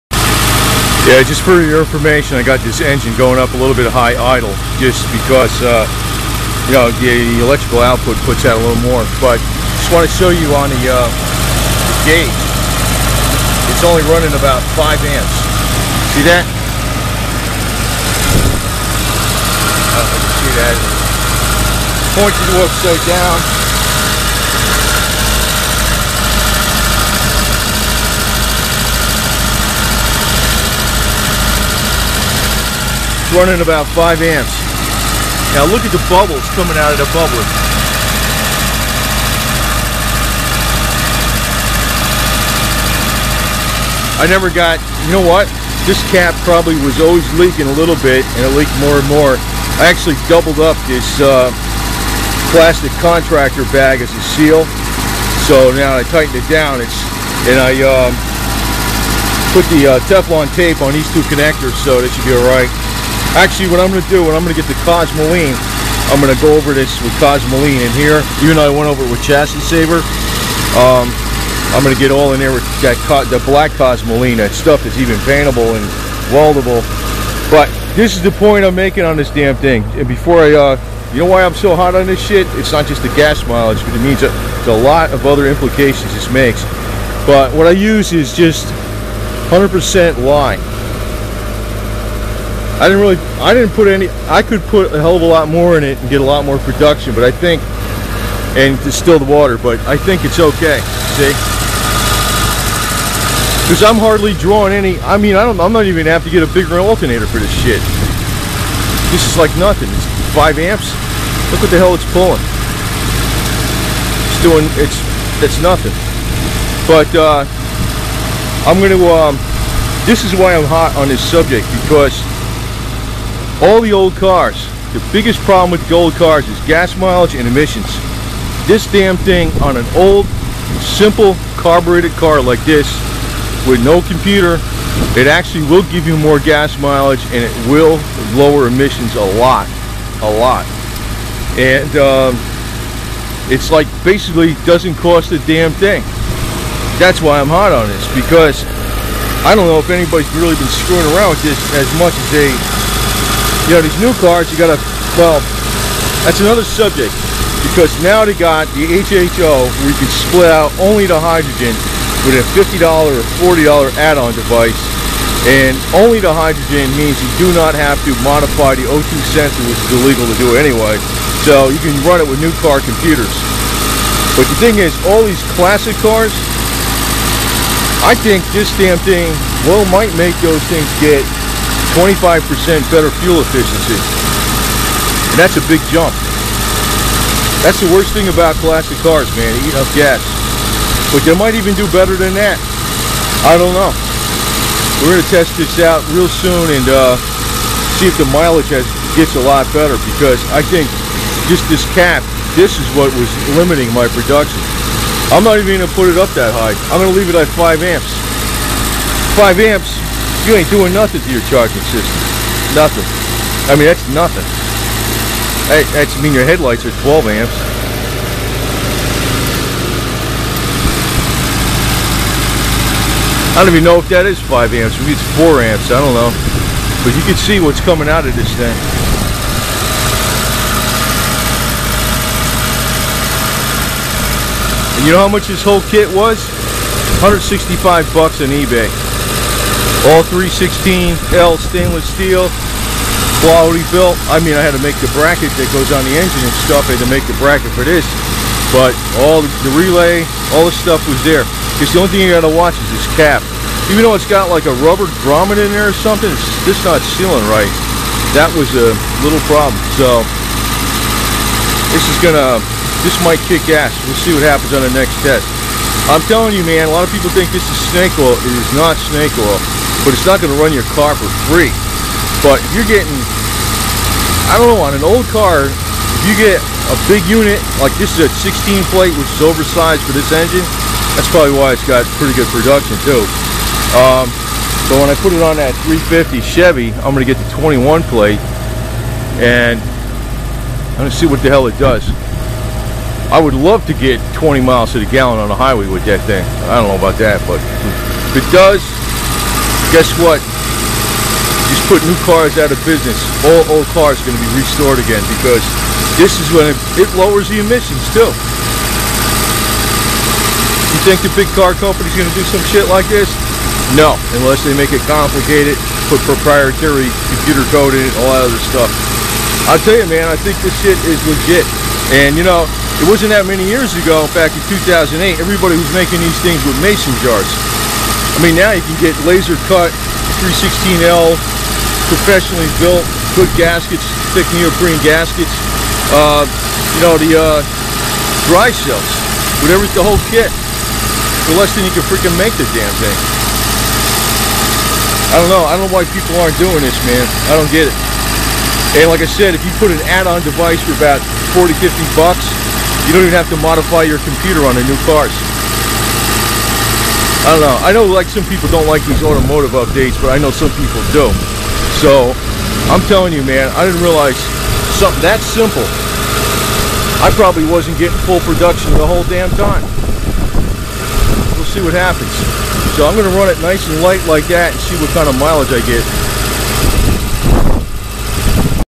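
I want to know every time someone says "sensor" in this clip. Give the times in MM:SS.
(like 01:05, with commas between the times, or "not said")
02:49.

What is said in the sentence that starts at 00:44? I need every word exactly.
I never got, you know what?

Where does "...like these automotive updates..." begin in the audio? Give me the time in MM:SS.
05:58.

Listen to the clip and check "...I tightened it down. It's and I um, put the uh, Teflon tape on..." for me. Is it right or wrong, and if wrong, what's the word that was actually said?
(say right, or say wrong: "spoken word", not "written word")
right.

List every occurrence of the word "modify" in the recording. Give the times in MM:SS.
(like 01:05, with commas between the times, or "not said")
02:48, 05:53.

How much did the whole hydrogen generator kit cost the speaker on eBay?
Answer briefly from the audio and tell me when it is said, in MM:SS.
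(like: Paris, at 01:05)
$165, at 03:57.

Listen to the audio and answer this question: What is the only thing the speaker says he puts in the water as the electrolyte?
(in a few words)
lye.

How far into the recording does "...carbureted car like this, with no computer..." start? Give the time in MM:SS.
02:11.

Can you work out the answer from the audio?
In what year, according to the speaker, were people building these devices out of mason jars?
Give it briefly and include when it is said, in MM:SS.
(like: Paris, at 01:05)
2008, at 05:24.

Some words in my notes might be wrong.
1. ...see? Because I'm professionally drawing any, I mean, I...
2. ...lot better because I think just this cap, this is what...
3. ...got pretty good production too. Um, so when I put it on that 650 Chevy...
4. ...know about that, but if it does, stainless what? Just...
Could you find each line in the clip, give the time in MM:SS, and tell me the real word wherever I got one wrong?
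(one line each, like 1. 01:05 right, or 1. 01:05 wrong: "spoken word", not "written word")
1. 01:41 wrong: "hardly", not "professionally"
2. 03:19 right
3. 04:41 wrong: "350", not "650"
4. 04:56 wrong: "guess", not "stainless".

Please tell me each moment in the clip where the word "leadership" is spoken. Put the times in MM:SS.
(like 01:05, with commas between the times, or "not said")
not said.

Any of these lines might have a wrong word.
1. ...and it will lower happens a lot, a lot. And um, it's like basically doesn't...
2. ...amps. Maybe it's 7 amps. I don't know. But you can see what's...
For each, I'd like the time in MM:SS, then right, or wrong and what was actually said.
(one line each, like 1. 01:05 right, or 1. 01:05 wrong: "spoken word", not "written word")
1. 02:17 wrong: "emissions", not "happens"
2. 03:44 wrong: "4", not "7".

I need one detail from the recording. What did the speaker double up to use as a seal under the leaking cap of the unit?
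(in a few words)
plastic contractor bag.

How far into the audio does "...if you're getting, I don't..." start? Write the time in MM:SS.
04:32.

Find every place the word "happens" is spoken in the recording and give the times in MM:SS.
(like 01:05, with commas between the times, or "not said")
04:24, 06:11.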